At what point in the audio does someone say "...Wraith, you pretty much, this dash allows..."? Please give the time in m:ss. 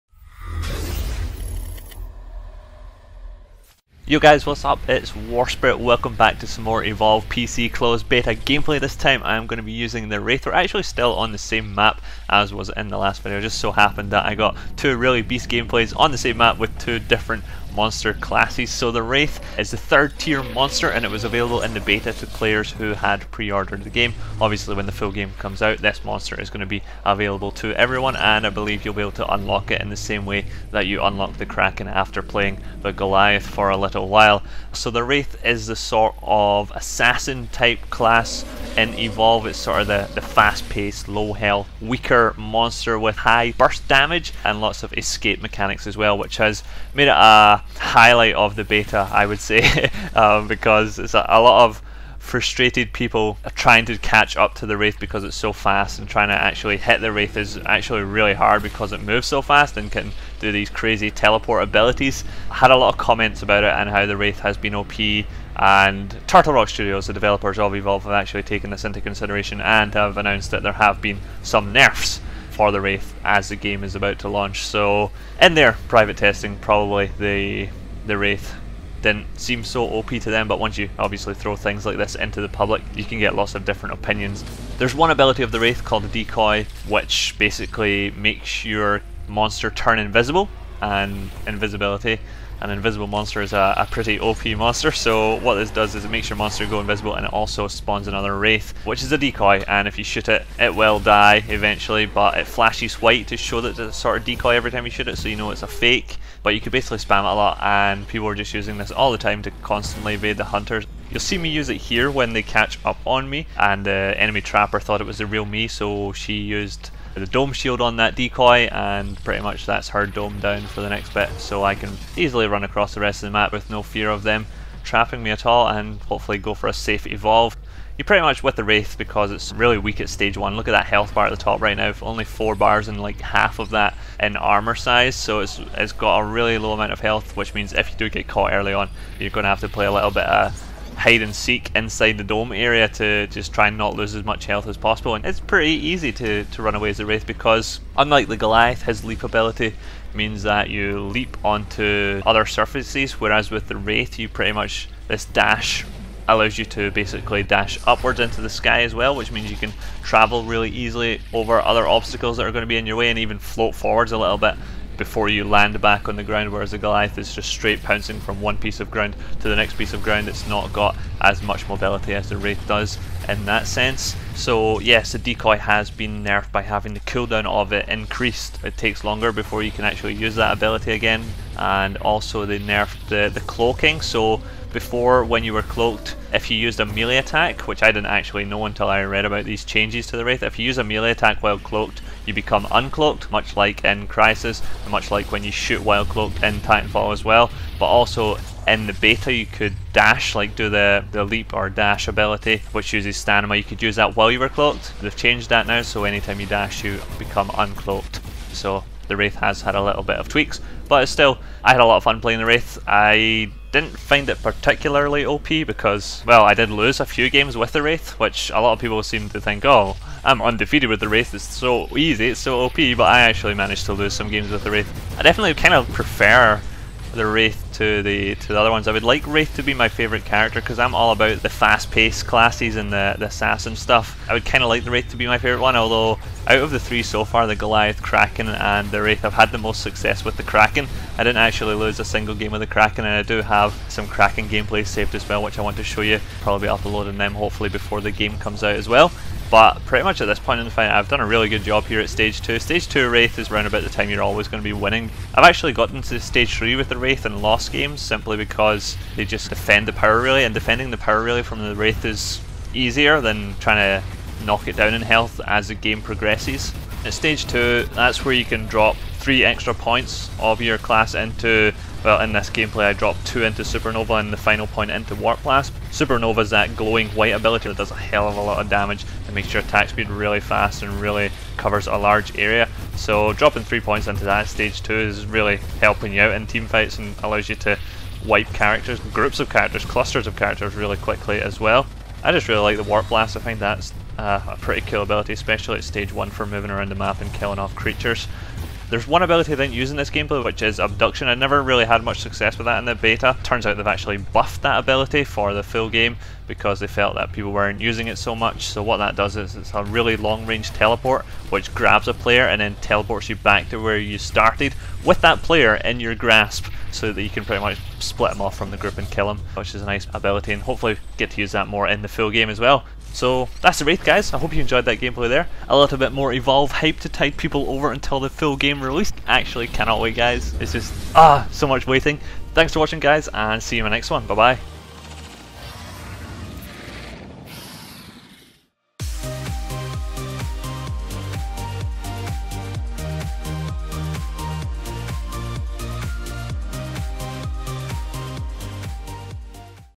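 2:33.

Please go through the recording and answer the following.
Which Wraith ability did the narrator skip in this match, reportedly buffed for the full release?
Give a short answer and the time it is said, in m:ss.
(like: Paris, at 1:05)
Abduction, at 5:00.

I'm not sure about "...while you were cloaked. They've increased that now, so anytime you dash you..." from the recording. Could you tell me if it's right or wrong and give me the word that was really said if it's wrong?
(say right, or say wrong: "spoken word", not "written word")
wrong: "changed", not "increased".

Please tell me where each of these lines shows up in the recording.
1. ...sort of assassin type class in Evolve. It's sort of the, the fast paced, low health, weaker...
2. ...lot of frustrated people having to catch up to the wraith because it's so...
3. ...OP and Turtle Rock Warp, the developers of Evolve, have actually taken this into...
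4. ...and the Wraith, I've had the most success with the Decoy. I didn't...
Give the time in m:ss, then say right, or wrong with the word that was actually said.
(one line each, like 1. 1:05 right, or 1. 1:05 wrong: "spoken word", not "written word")
1. 0:35 right
2. 0:51 wrong: "trying", not "having"
3. 1:04 wrong: "Studios", not "Warp"
4. 3:58 wrong: "Kraken", not "Decoy".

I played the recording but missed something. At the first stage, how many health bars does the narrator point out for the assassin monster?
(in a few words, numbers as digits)
4.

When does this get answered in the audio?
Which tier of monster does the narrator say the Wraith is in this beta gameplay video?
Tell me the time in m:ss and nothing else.
0:19.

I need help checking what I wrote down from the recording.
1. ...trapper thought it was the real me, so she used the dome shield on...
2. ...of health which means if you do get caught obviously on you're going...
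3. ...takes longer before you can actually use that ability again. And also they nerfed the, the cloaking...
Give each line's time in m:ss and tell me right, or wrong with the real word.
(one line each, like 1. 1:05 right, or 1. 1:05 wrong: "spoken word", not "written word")
1. 1:54 right
2. 2:16 wrong: "early", not "obviously"
3. 2:58 right.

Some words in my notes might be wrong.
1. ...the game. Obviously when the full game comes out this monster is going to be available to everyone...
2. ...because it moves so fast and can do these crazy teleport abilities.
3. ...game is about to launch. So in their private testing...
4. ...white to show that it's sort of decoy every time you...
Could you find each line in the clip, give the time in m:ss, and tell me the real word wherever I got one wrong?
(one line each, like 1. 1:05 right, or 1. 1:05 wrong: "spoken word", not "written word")
1. 0:23 right
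2. 0:58 right
3. 1:13 right
4. 1:43 right.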